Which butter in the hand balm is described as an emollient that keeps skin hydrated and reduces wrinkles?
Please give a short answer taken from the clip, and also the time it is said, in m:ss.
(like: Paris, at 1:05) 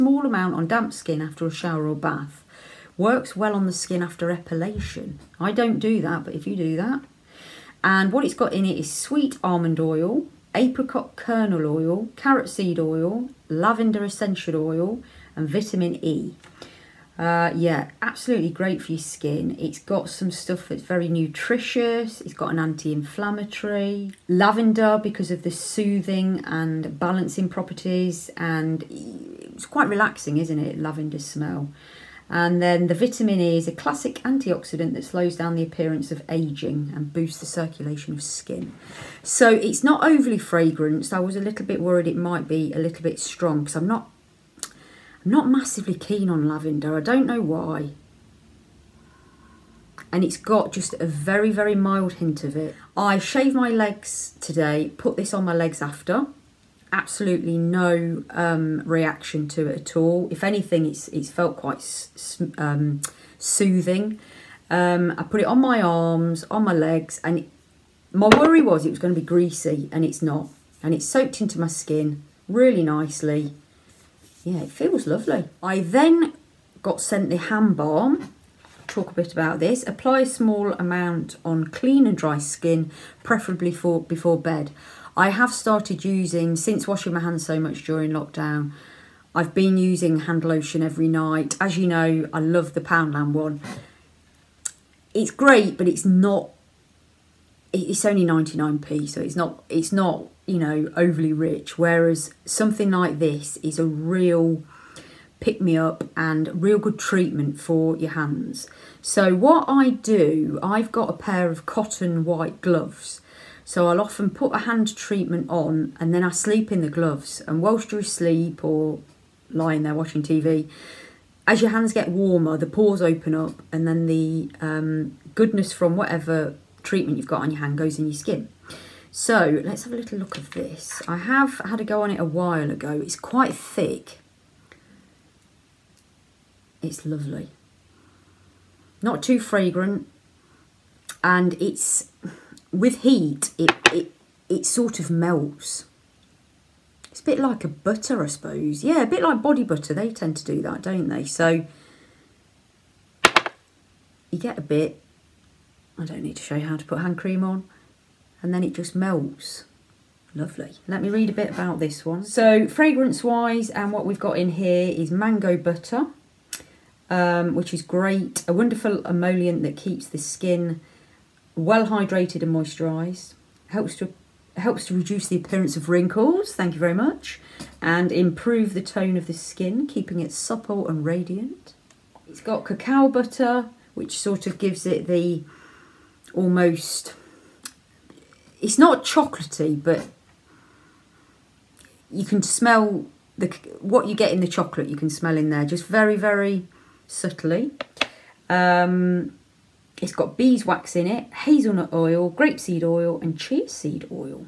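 Mango butter, at 2:45.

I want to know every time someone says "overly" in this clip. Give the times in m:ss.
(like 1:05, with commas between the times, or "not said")
0:40, 1:40.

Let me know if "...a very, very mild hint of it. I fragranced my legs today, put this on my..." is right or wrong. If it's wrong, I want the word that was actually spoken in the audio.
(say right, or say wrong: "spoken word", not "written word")
wrong: "shaved", not "fragranced".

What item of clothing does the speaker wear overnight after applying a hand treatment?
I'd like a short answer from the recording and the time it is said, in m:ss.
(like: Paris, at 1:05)
Cotton white gloves, at 1:51.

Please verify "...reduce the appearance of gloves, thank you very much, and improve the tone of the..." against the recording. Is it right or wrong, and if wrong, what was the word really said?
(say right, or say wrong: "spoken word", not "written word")
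wrong: "wrinkles", not "gloves".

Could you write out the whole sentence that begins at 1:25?
I have started using, since washing my hands so much during lockdown, I've been using hand lotion every night.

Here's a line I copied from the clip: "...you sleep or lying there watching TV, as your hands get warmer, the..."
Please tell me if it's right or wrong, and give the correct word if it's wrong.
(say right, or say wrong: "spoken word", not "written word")
right.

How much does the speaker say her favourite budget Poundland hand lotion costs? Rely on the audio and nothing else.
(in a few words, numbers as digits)
99p.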